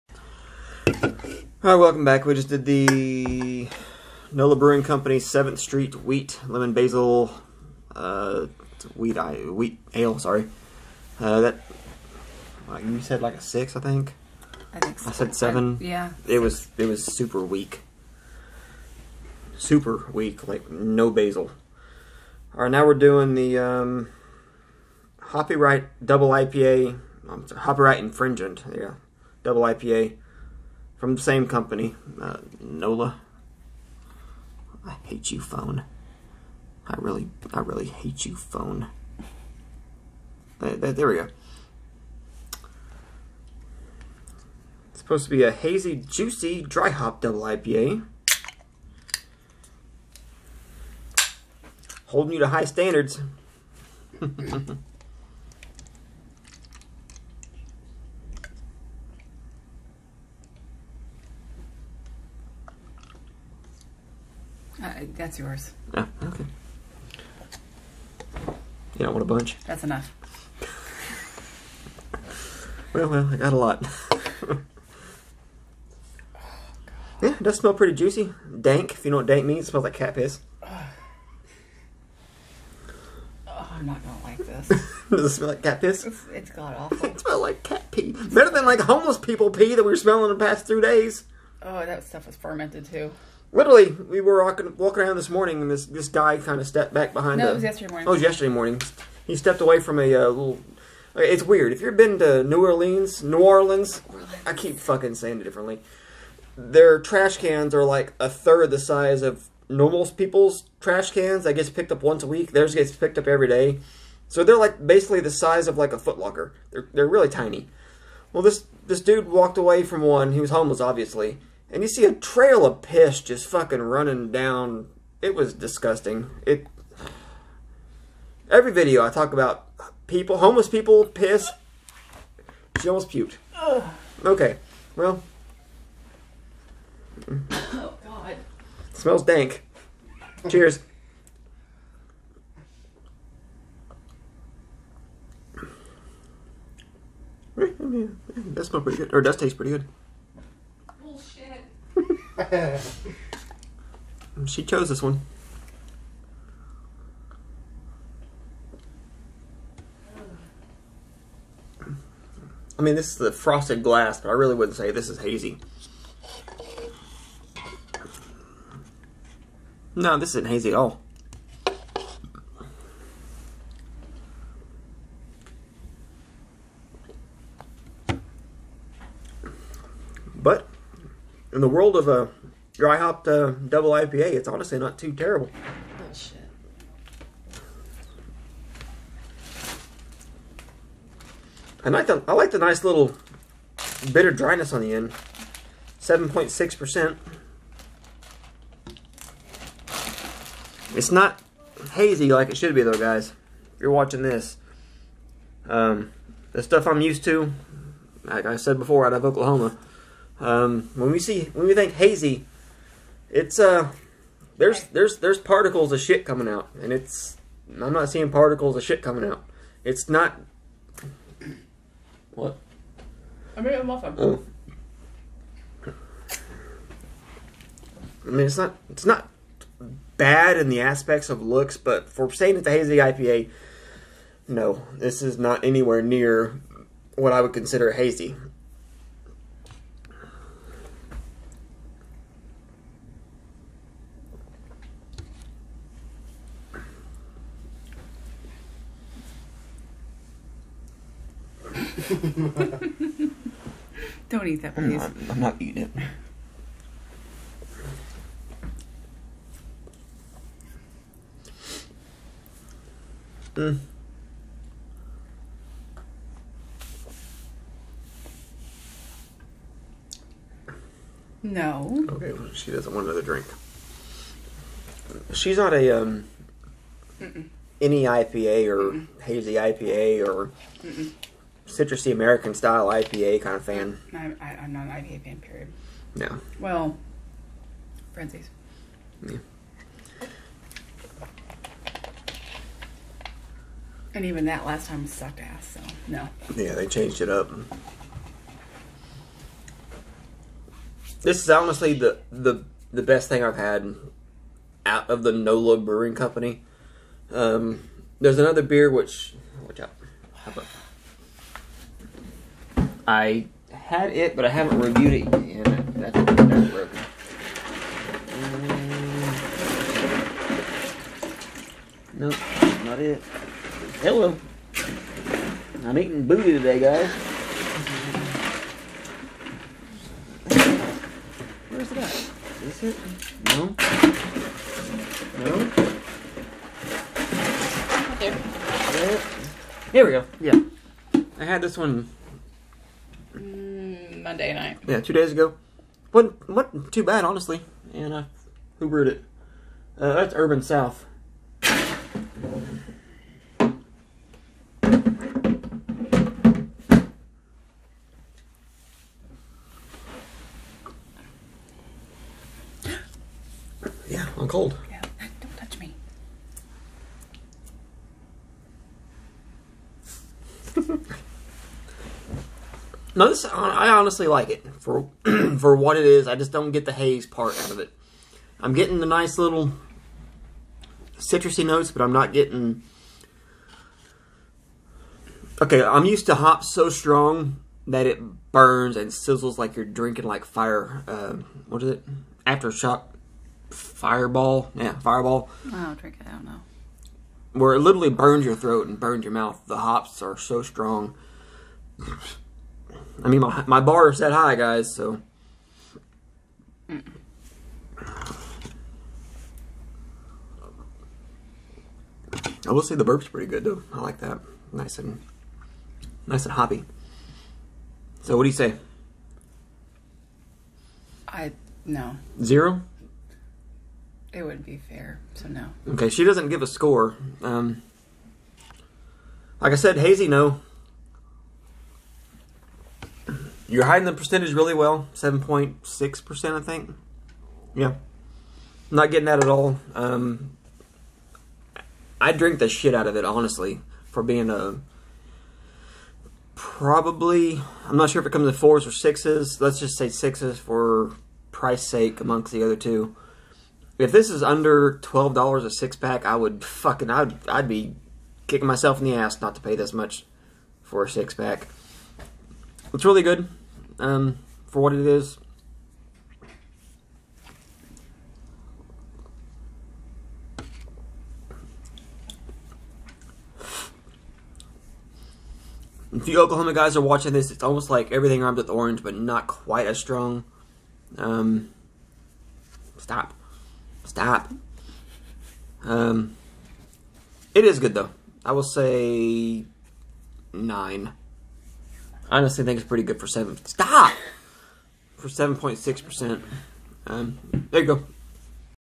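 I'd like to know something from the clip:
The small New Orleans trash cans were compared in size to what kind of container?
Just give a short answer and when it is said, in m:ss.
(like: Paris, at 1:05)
footlocker, at 1:55.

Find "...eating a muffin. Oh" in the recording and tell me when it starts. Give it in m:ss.
3:43.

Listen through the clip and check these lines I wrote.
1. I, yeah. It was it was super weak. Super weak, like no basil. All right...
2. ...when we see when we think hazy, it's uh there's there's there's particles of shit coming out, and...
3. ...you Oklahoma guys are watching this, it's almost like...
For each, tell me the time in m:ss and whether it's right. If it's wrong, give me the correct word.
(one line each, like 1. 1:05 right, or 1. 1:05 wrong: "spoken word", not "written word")
1. 0:15 right
2. 3:30 right
3. 7:56 right.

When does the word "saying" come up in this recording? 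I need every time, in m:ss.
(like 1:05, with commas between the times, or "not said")
1:45, 3:52.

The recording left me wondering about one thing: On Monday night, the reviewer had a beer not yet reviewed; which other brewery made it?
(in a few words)
Urban South.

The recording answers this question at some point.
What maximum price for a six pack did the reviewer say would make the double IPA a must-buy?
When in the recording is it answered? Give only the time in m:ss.
7:35.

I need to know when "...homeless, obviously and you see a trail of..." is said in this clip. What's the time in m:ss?
2:00.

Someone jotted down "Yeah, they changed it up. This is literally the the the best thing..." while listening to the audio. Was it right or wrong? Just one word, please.
wrong.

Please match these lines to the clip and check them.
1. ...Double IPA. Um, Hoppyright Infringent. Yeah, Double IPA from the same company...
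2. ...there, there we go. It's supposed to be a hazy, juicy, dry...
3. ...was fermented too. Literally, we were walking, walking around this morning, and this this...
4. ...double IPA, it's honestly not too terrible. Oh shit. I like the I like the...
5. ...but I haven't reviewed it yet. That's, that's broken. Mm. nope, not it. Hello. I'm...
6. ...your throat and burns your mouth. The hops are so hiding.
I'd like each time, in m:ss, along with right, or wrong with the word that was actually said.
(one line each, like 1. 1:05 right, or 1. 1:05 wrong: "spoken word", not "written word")
1. 0:26 right
2. 0:40 right
3. 1:32 right
4. 3:03 right
5. 5:14 right
6. 6:38 wrong: "strong", not "hiding".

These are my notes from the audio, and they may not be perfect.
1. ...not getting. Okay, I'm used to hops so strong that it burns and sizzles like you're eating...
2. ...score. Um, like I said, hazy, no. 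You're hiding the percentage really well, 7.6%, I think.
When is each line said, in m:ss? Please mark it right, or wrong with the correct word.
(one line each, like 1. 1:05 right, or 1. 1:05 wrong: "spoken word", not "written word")
1. 6:22 wrong: "drinking", not "eating"
2. 7:06 right.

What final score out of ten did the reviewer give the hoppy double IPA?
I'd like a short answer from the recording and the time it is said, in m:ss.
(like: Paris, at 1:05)
9, at 8:10.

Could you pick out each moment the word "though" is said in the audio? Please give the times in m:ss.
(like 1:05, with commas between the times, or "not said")
3:22, 6:53, 8:07.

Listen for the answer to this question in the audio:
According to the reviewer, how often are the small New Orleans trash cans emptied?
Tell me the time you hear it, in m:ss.
1:53.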